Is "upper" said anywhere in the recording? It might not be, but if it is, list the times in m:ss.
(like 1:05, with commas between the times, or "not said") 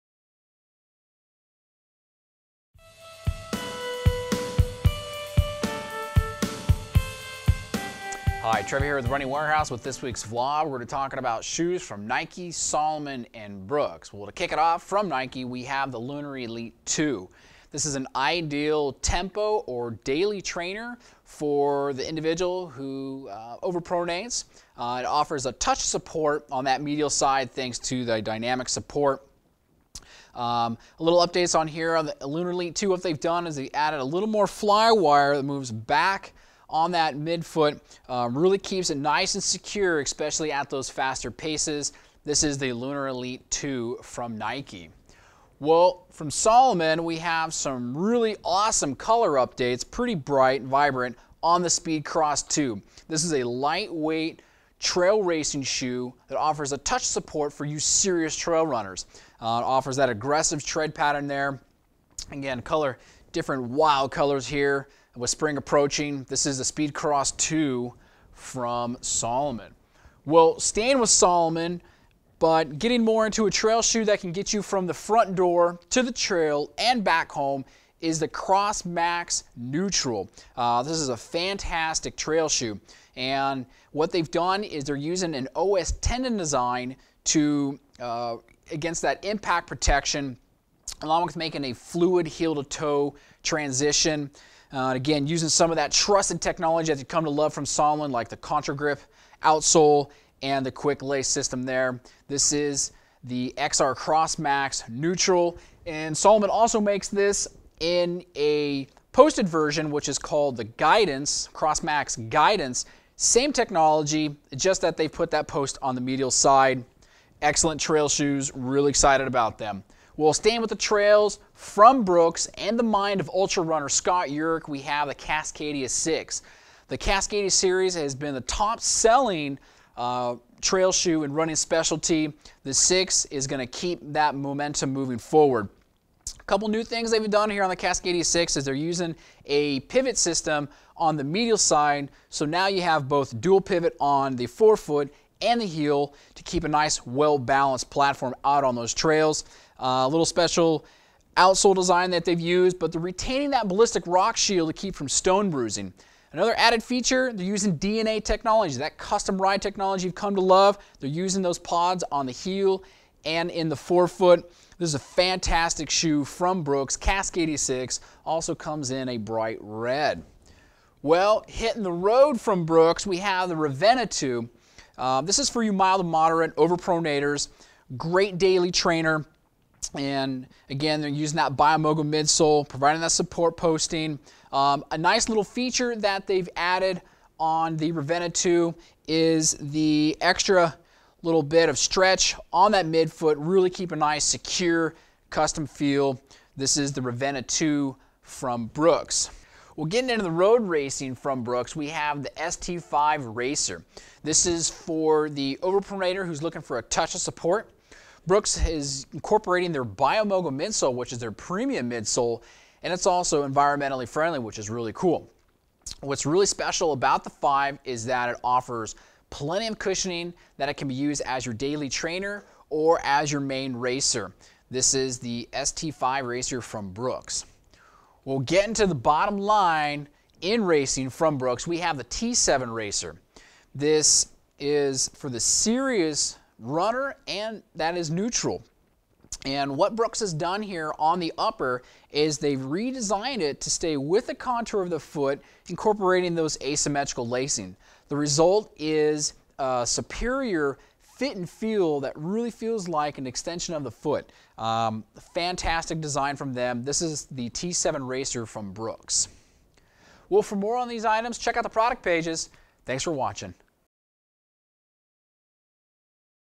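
4:01.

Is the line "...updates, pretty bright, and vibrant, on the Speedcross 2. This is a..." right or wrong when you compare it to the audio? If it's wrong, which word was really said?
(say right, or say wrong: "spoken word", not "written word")
right.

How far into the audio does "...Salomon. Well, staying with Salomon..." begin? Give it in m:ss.
1:09.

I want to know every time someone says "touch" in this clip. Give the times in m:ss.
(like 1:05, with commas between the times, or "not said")
0:25, 0:56, 3:26.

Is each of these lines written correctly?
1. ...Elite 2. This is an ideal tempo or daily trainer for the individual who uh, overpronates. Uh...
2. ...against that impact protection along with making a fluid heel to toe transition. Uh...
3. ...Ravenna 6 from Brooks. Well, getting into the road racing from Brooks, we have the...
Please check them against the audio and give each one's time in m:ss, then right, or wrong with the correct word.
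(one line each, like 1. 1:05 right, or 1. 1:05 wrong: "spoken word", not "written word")
1. 0:16 right
2. 1:28 right
3. 3:17 wrong: "2", not "6".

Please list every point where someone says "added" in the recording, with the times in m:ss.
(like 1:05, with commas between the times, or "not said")
0:33, 2:36, 3:06.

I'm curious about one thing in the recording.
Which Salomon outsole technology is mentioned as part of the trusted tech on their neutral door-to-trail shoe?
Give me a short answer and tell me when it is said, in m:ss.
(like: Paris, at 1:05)
ContraGrip, at 1:38.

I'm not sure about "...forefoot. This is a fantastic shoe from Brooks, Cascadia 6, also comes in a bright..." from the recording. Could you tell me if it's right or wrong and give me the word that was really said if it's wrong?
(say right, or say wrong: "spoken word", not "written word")
right.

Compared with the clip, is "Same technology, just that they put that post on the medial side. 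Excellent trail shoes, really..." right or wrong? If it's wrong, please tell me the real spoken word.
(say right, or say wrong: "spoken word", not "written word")
right.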